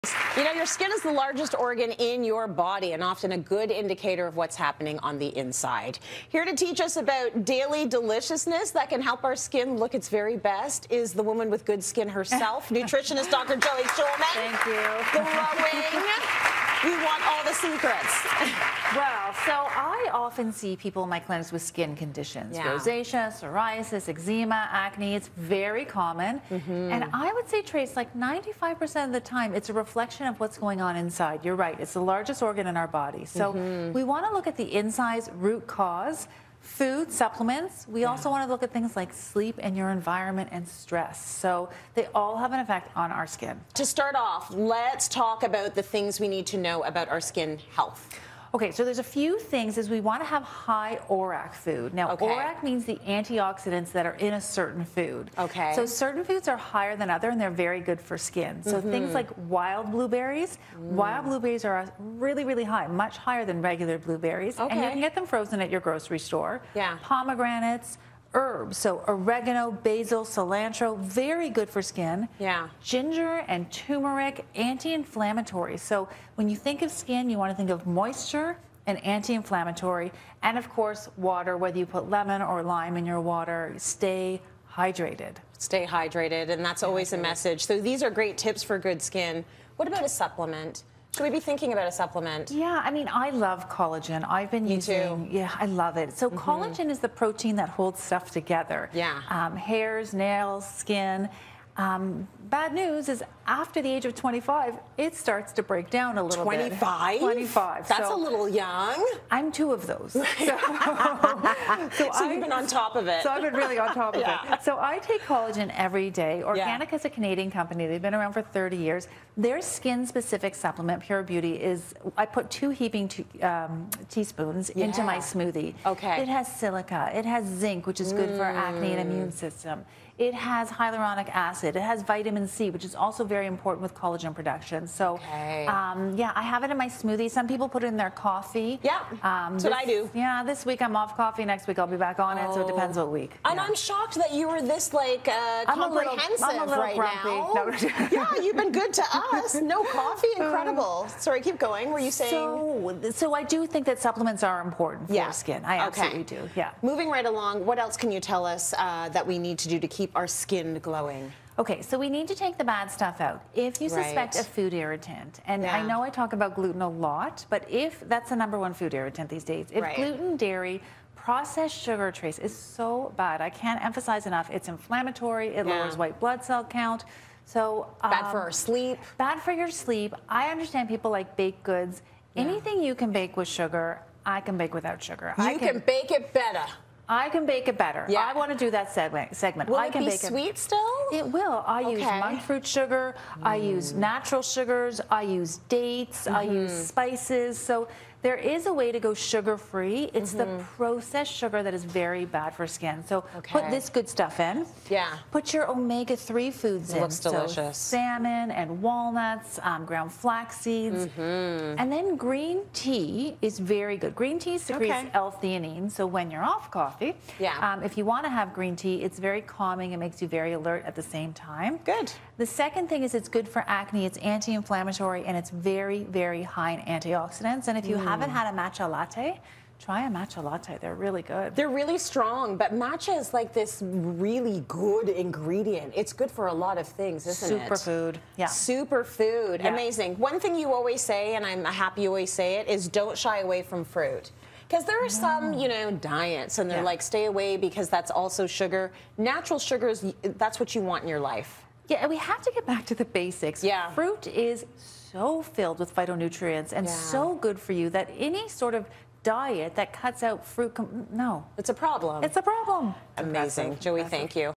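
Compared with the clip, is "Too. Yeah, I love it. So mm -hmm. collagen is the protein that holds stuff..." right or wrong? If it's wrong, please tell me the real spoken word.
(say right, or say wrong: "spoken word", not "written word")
right.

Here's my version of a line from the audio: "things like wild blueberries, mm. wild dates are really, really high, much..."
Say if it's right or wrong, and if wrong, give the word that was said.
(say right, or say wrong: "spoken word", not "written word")
wrong: "blueberries", not "dates".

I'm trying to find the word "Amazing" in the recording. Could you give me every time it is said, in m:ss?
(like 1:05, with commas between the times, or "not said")
3:59, 4:23.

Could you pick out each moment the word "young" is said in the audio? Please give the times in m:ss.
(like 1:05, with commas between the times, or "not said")
1:48.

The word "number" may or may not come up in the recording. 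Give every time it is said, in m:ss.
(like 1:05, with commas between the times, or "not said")
2:48.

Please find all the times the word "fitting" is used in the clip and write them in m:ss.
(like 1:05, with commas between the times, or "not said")
not said.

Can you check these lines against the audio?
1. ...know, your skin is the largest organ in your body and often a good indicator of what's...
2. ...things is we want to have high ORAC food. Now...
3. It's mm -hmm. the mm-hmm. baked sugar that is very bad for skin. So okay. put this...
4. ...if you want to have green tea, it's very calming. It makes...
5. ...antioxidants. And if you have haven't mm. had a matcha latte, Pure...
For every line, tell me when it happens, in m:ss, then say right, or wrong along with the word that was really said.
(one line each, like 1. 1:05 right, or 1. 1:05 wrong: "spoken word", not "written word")
1. 0:00 right
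2. 0:49 right
3. 3:20 wrong: "processed", not "baked"
4. 3:37 right
5. 3:46 wrong: "Try", not "Pure".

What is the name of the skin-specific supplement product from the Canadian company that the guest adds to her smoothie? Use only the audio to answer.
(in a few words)
Pure Beauty.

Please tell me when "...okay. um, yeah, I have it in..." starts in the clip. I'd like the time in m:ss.
2:15.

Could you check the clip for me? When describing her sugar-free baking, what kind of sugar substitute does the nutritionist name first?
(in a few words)
Monk fruit sugar.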